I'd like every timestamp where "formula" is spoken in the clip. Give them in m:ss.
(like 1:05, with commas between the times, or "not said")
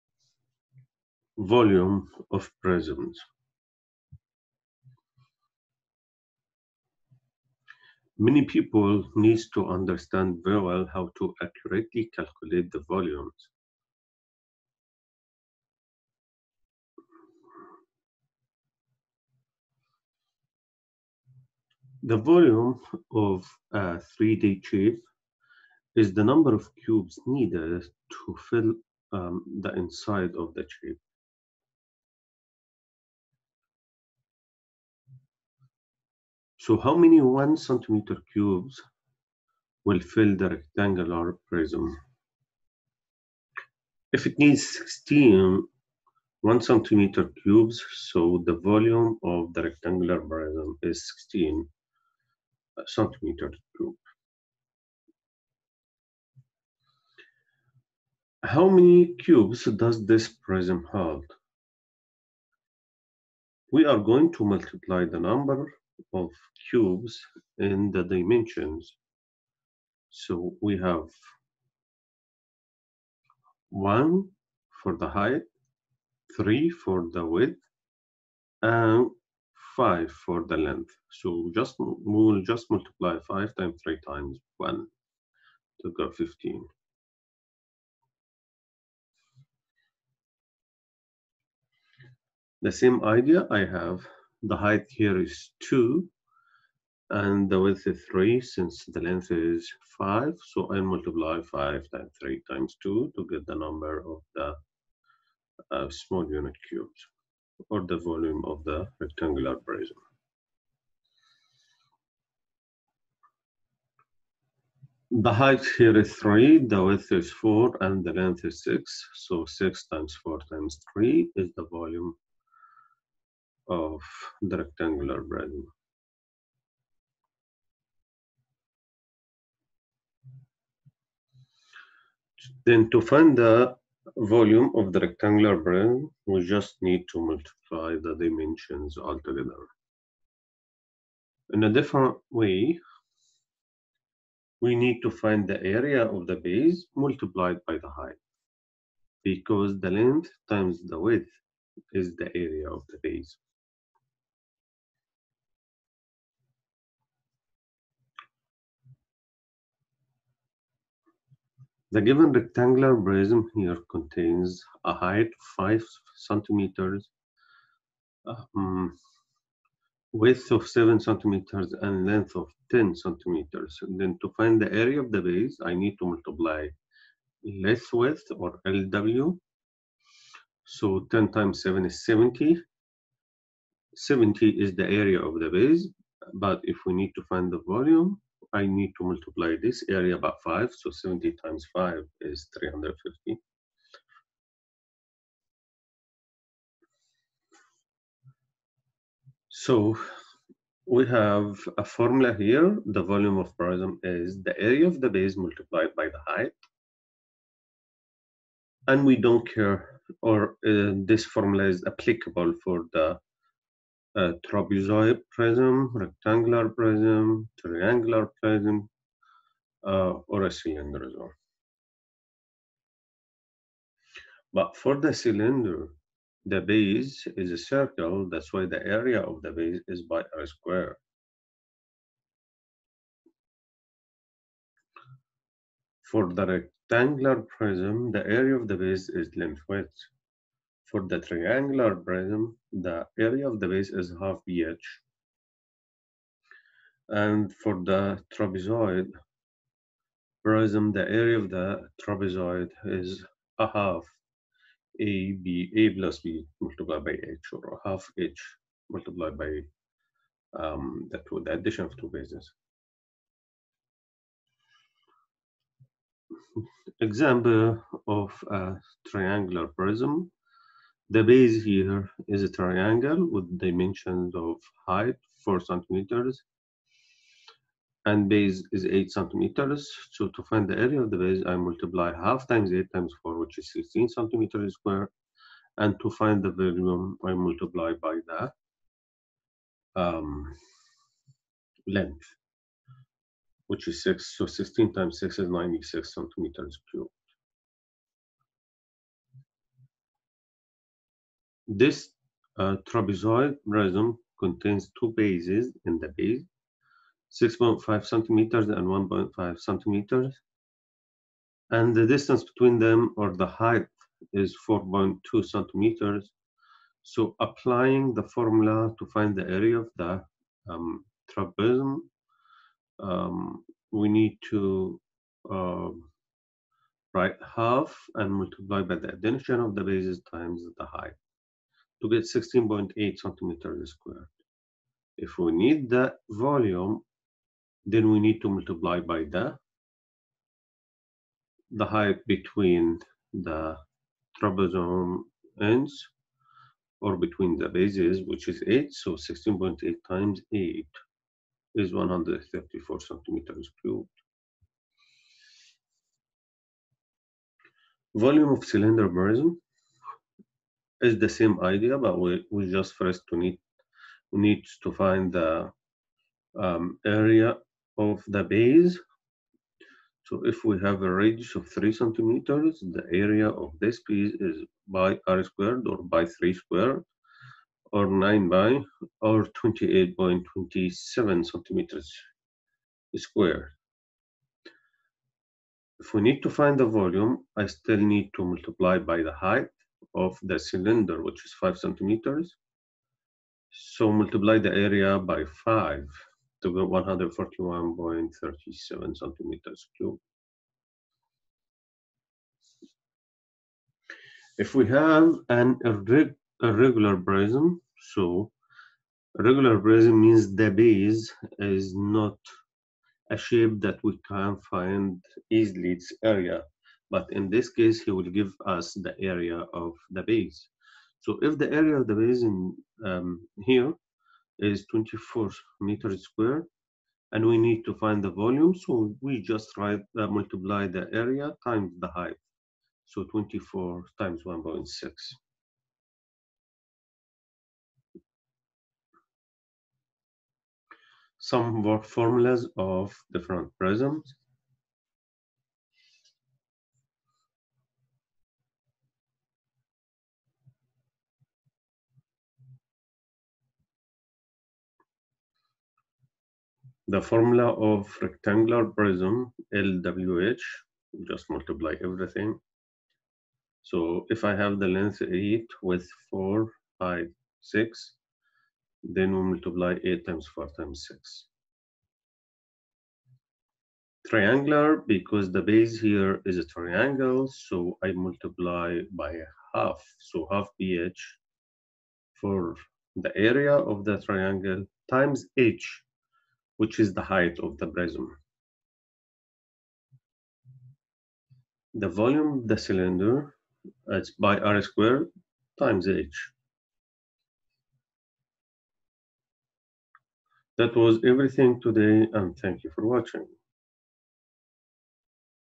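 3:21, 3:31, 5:18, 7:22, 7:37.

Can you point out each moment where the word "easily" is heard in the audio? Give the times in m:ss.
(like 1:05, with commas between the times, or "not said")
6:55.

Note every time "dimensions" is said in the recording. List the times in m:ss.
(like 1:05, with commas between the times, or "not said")
1:08, 2:18, 4:33.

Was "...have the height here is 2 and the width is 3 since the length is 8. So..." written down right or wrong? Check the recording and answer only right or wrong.
wrong.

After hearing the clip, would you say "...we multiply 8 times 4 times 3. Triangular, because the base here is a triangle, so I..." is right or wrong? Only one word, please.
wrong.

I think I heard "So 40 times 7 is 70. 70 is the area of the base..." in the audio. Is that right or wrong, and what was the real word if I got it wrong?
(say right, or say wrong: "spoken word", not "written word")
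wrong: "10", not "40".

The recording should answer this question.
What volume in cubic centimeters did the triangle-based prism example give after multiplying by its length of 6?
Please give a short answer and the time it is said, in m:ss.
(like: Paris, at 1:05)
96, at 4:55.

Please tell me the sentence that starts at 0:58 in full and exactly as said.
How many cubes does this prism hold?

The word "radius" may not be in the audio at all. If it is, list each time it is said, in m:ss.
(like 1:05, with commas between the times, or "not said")
6:11.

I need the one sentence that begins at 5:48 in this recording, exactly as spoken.
So 16.8 times 8 is 134 centimeters cubed.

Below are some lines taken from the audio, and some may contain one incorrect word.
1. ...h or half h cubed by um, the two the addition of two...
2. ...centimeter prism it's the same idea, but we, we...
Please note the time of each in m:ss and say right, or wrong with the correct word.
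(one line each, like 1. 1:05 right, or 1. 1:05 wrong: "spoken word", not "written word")
1. 4:17 wrong: "multiplied", not "cubed"
2. 5:58 wrong: "cylinder", not "centimeter".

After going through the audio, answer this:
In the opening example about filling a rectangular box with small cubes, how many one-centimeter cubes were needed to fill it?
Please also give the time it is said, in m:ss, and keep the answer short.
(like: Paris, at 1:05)
16, at 0:44.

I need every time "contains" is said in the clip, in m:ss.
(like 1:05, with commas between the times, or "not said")
2:43, 5:04.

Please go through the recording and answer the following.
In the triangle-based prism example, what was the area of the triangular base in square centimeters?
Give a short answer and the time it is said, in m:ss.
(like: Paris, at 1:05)
16, at 4:43.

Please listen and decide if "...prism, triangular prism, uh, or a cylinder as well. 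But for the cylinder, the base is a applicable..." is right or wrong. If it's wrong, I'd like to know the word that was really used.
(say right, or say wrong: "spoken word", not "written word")
wrong: "circle", not "applicable".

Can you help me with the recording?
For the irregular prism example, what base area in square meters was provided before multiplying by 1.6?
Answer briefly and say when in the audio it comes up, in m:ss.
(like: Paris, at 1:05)
24 meters squared, at 7:04.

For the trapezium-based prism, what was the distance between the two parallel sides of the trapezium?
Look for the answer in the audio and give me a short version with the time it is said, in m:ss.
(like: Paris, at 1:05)
4.2 centimeters, at 5:14.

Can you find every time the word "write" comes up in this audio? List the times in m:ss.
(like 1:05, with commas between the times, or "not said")
5:27, 7:09.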